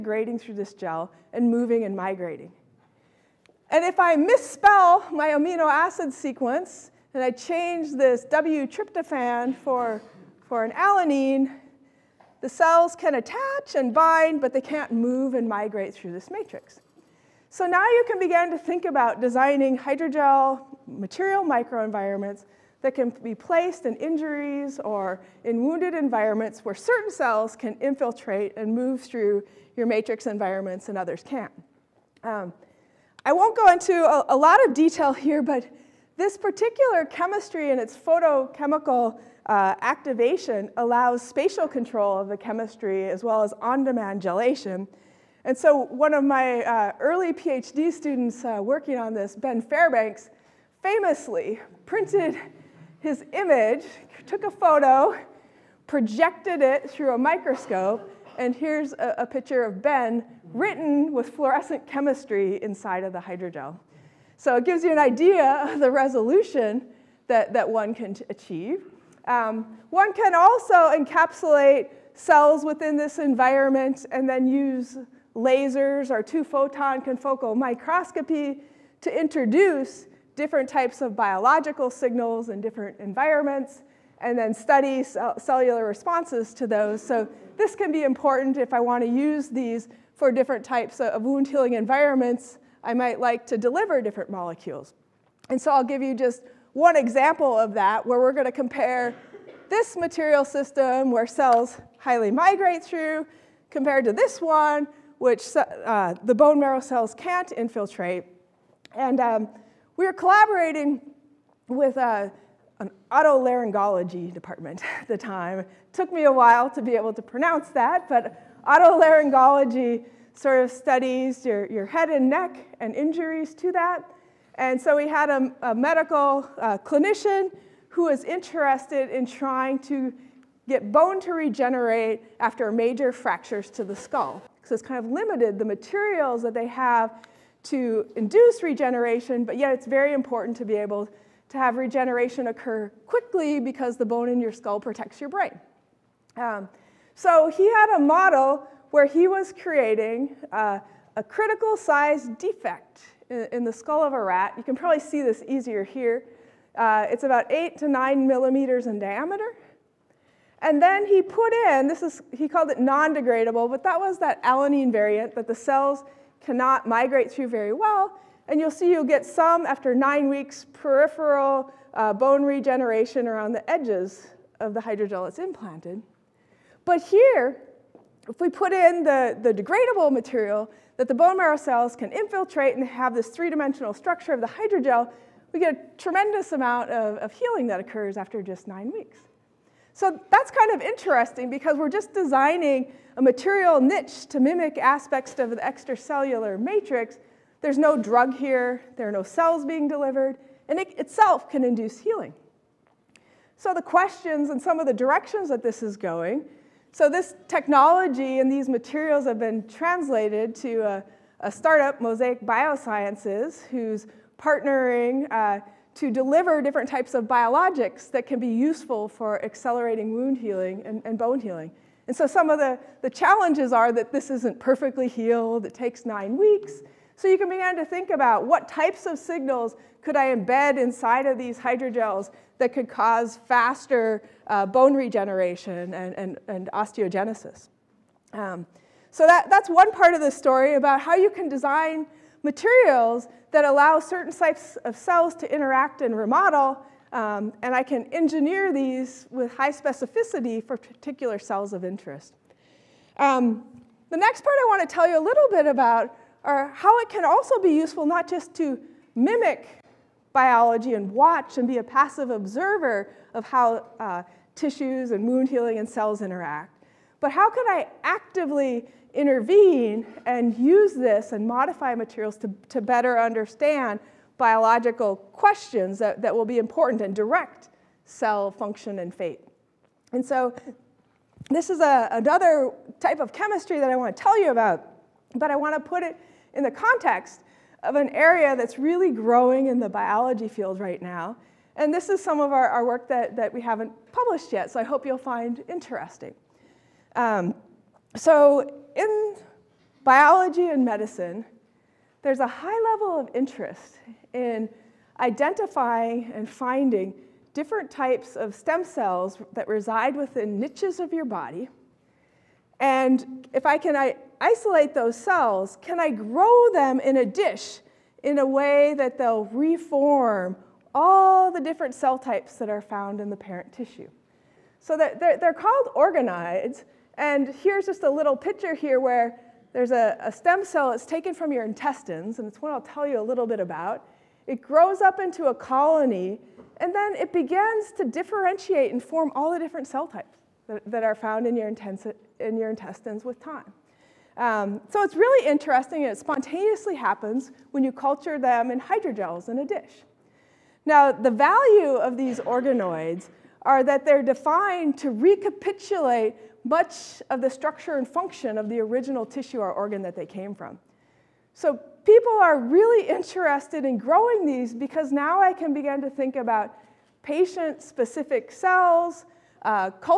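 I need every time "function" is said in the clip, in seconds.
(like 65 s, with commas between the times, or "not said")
278 s, 358 s.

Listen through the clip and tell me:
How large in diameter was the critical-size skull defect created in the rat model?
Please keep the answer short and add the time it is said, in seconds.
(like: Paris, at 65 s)
8 to 9 millimeters, at 157 s.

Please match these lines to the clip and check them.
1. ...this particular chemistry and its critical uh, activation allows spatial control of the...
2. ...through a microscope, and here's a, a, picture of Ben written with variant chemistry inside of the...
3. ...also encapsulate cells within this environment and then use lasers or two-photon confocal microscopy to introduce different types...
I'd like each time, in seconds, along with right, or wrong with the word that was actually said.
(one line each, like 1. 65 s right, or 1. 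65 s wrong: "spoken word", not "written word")
1. 36 s wrong: "photochemical", not "critical"
2. 56 s wrong: "fluorescent", not "variant"
3. 70 s right.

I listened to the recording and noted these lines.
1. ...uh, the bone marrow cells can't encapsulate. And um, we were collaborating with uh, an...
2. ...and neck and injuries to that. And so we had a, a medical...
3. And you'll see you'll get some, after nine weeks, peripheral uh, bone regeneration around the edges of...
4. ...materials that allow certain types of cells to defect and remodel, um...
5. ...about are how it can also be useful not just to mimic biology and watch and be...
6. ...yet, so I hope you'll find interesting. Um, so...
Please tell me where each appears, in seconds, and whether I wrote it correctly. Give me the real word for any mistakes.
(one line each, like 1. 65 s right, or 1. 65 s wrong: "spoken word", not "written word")
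1. 105 s wrong: "infiltrate", not "encapsulate"
2. 122 s right
3. 168 s right
4. 242 s wrong: "interact", not "defect"
5. 255 s right
6. 294 s right.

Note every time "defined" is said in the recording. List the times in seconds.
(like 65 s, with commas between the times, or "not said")
354 s.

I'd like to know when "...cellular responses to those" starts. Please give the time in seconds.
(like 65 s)
85 s.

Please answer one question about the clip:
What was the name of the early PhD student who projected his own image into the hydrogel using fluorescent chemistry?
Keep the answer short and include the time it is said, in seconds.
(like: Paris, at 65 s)
Ben Fairbanks, at 49 s.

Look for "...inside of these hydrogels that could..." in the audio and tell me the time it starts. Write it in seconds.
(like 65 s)
230 s.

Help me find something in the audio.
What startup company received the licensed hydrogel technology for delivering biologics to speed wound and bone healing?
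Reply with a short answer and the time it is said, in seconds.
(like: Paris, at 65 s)
Mosaic Biosciences, at 212 s.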